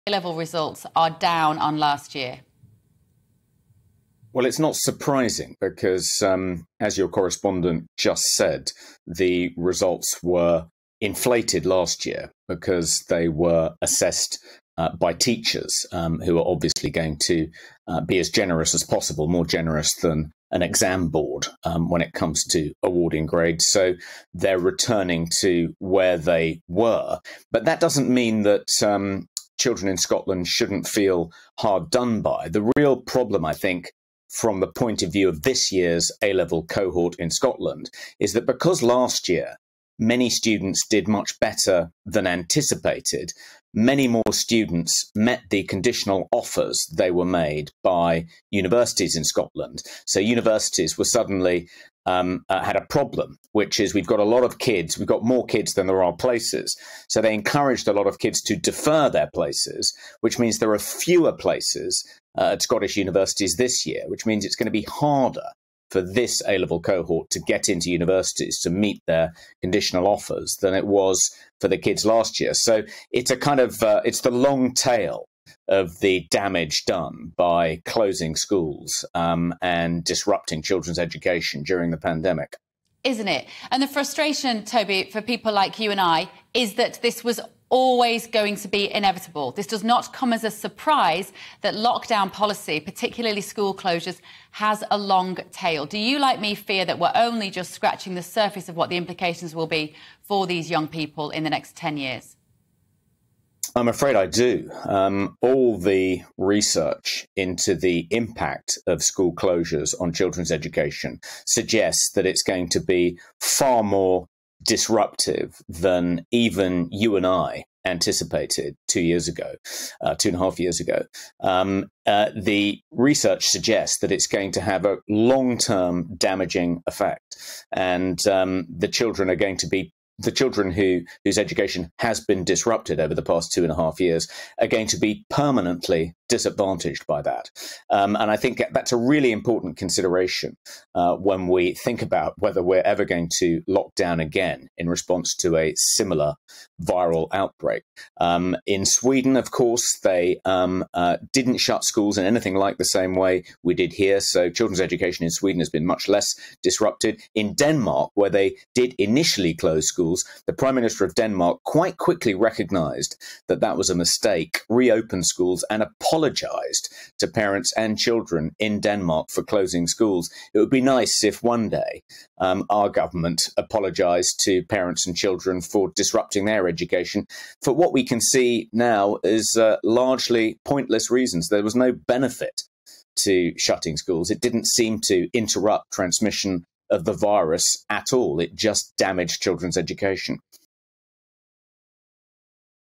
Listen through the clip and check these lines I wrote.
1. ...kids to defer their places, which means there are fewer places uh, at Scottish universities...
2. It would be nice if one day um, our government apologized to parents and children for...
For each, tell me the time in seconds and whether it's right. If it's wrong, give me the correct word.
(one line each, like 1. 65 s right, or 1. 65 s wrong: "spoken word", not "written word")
1. 58 s right
2. 170 s right.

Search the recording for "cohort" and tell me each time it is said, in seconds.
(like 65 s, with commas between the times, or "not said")
36 s, 66 s.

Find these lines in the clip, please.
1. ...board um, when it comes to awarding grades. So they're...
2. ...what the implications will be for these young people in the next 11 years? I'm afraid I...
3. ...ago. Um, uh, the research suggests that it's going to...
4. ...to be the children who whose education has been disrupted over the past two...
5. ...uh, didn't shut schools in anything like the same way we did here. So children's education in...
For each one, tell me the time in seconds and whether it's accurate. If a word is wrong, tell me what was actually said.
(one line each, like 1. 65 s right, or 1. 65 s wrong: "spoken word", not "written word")
1. 21 s right
2. 98 s wrong: "10", not "11"
3. 120 s right
4. 129 s right
5. 150 s right.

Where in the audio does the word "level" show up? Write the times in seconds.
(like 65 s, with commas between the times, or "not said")
0 s, 36 s, 66 s.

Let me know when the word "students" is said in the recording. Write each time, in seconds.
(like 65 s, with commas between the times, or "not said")
40 s, 44 s.